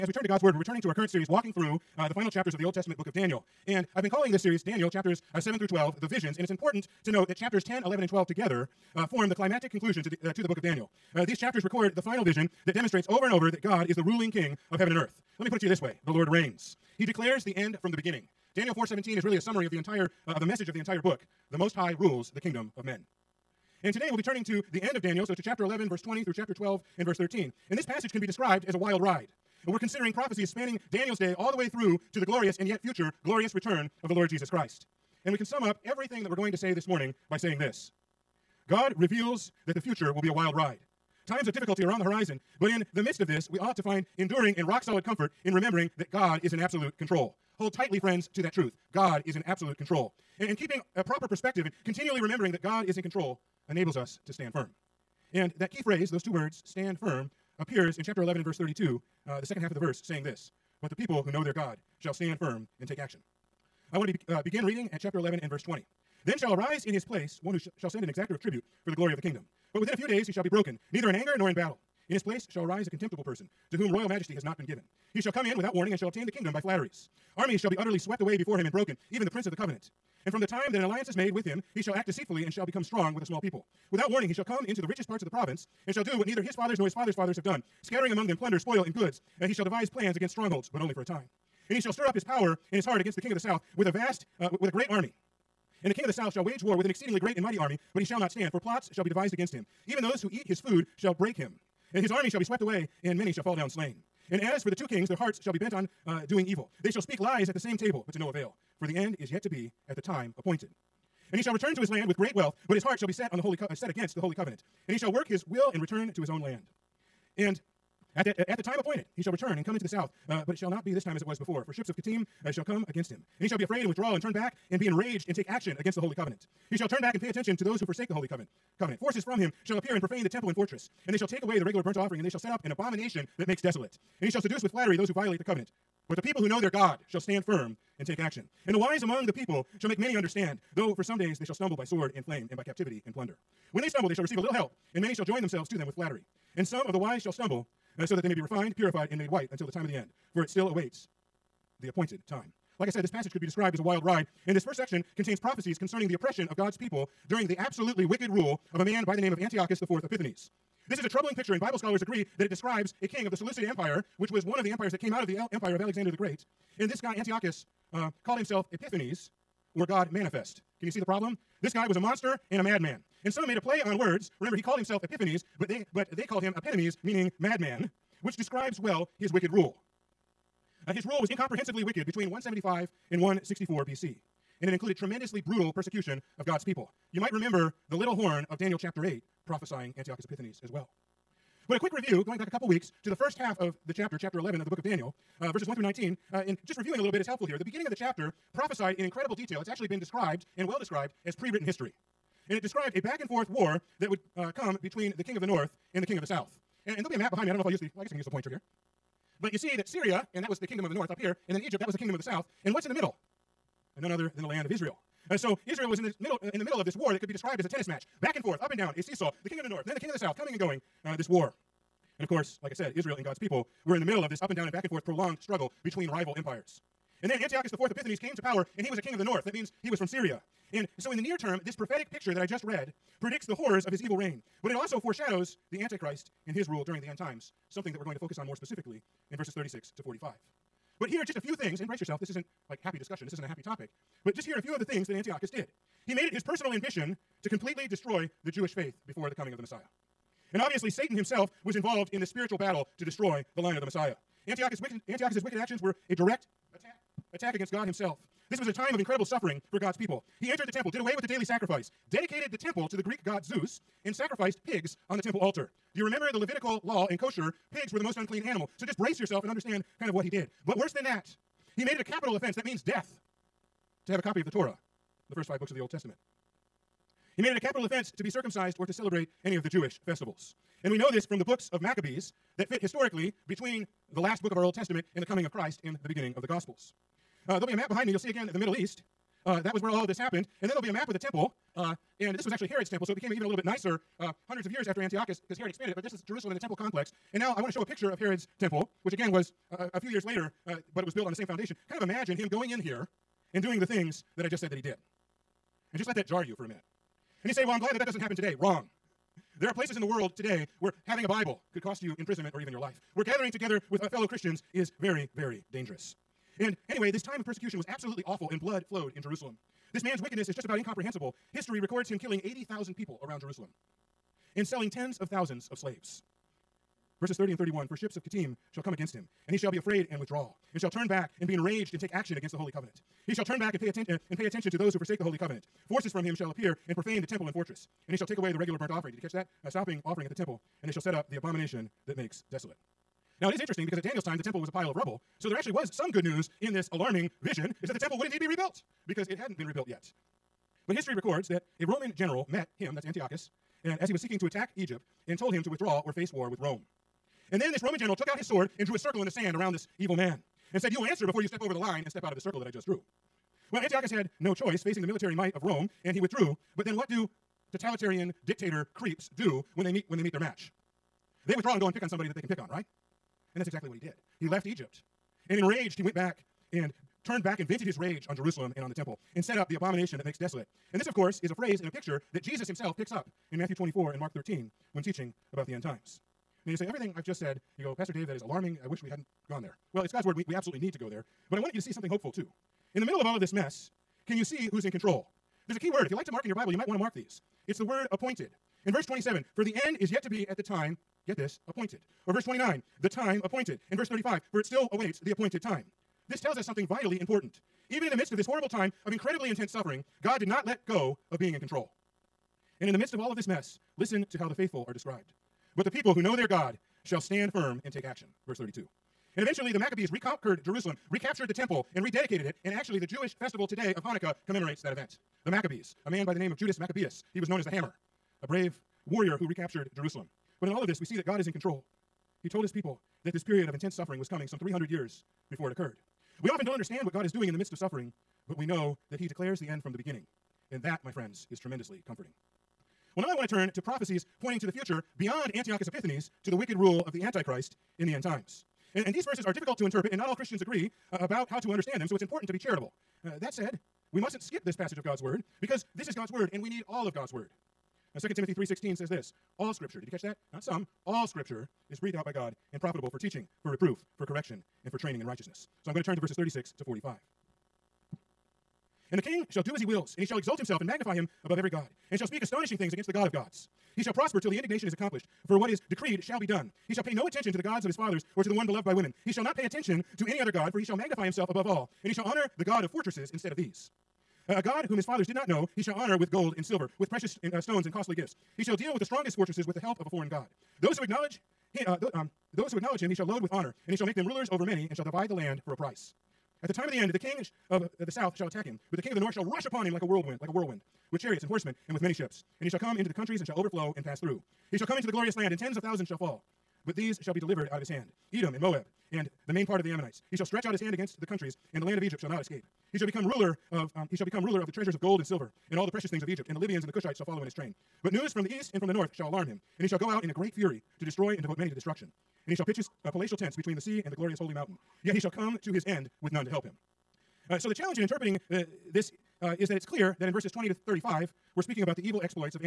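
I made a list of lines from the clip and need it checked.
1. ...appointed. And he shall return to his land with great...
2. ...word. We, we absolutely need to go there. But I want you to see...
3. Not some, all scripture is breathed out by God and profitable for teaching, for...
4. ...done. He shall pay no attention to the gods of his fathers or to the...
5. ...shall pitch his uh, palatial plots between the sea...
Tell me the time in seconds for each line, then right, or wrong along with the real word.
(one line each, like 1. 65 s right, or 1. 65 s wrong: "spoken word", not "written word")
1. 110 s right
2. 390 s right
3. 460 s right
4. 476 s right
5. 522 s wrong: "tents", not "plots".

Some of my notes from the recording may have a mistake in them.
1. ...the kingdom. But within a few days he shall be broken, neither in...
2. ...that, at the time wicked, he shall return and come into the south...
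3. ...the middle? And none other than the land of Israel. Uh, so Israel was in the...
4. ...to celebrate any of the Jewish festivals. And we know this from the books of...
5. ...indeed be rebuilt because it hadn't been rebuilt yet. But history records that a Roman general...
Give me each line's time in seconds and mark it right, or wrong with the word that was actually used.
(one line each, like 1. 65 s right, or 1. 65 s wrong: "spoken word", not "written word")
1. 69 s right
2. 118 s wrong: "appointed", not "wicked"
3. 212 s right
4. 278 s right
5. 348 s right.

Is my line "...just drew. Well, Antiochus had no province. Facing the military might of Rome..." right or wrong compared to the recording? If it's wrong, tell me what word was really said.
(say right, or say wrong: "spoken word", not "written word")
wrong: "choice", not "province".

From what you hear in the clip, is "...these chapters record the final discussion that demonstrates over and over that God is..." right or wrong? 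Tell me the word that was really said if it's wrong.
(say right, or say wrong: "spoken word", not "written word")
wrong: "vision", not "discussion".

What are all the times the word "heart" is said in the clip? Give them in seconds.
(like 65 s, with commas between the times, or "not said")
92 s, 105 s, 112 s.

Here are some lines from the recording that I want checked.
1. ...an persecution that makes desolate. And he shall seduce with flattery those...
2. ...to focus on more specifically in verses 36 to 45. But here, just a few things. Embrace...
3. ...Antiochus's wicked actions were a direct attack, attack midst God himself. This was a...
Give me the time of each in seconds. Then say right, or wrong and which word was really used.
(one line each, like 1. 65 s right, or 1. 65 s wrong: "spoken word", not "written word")
1. 132 s wrong: "abomination", not "persecution"
2. 238 s right
3. 255 s wrong: "against", not "midst".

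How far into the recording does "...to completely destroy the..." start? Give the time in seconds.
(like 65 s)
247 s.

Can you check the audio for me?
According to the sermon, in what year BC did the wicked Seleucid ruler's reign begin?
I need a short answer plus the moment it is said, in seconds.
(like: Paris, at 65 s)
175 BC, at 182 s.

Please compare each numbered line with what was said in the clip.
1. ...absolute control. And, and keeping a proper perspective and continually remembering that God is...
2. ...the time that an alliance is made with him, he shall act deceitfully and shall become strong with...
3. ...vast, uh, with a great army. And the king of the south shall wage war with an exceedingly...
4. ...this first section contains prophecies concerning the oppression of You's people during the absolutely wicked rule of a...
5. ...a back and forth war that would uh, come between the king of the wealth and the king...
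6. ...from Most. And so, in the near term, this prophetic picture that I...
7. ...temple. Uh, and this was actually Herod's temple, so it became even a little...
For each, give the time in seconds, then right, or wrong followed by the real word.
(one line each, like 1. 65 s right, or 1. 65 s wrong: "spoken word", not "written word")
1. 49 s right
2. 80 s right
3. 93 s right
4. 154 s wrong: "God", not "You"
5. 202 s wrong: "north", not "wealth"
6. 229 s wrong: "Syria", not "Most"
7. 291 s right.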